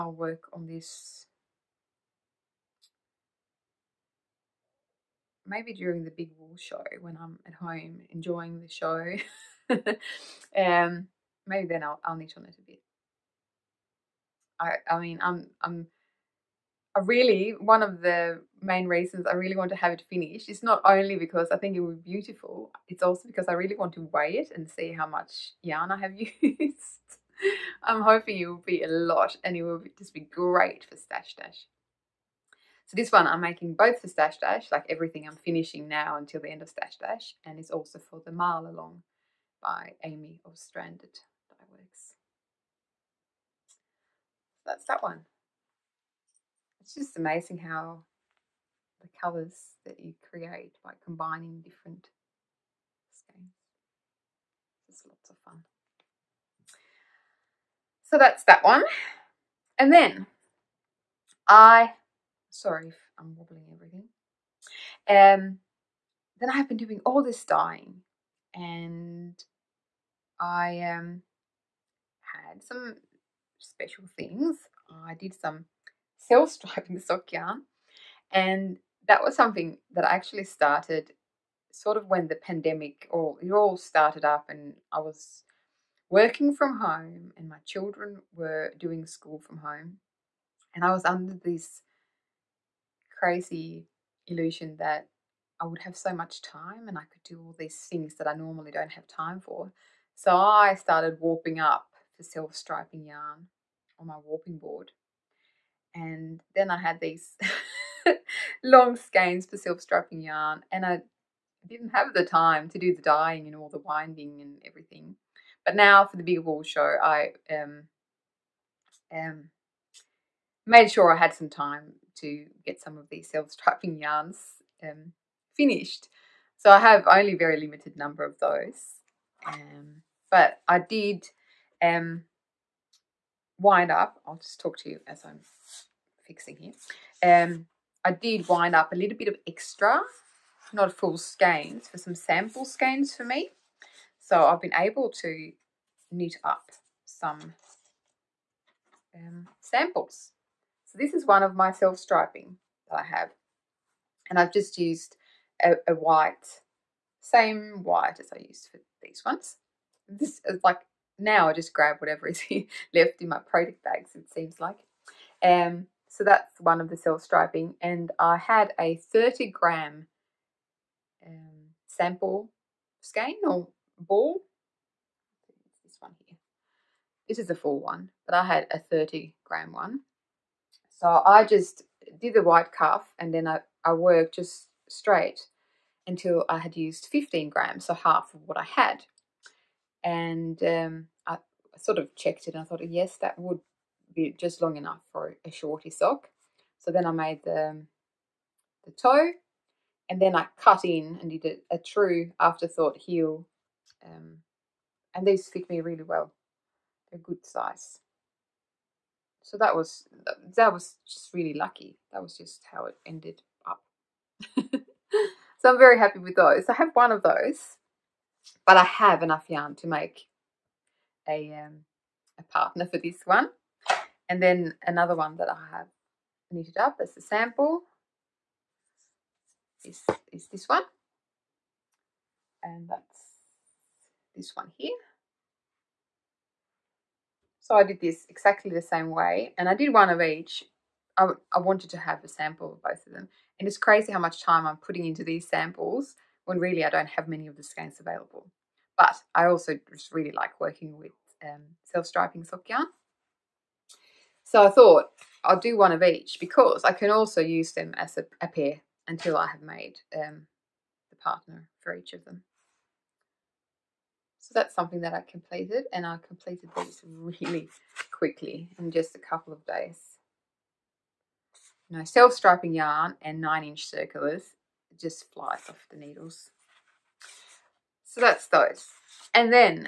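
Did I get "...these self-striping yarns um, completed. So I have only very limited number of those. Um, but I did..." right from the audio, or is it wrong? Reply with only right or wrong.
wrong.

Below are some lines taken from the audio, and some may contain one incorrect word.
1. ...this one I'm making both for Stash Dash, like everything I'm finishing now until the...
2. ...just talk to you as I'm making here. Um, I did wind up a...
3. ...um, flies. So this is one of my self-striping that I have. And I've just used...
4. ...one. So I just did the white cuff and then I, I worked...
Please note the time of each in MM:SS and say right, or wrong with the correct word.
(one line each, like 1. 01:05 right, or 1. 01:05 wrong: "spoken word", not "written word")
1. 00:32 right
2. 02:14 wrong: "fixing", not "making"
3. 02:29 wrong: "samples", not "flies"
4. 02:59 right.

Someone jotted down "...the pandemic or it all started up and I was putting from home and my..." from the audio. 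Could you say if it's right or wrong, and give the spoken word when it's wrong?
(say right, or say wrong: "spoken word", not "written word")
wrong: "working", not "putting".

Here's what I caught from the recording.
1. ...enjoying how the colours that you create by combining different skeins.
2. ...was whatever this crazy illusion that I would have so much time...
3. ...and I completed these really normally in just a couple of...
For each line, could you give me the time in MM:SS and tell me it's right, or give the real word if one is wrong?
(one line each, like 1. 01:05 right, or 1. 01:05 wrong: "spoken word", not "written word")
1. 00:47 wrong: "amazing", not "enjoying"
2. 01:30 wrong: "under", not "whatever"
3. 04:25 wrong: "quickly", not "normally".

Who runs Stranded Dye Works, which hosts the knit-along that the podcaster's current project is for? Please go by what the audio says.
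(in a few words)
Amy.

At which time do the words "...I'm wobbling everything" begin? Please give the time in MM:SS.
01:03.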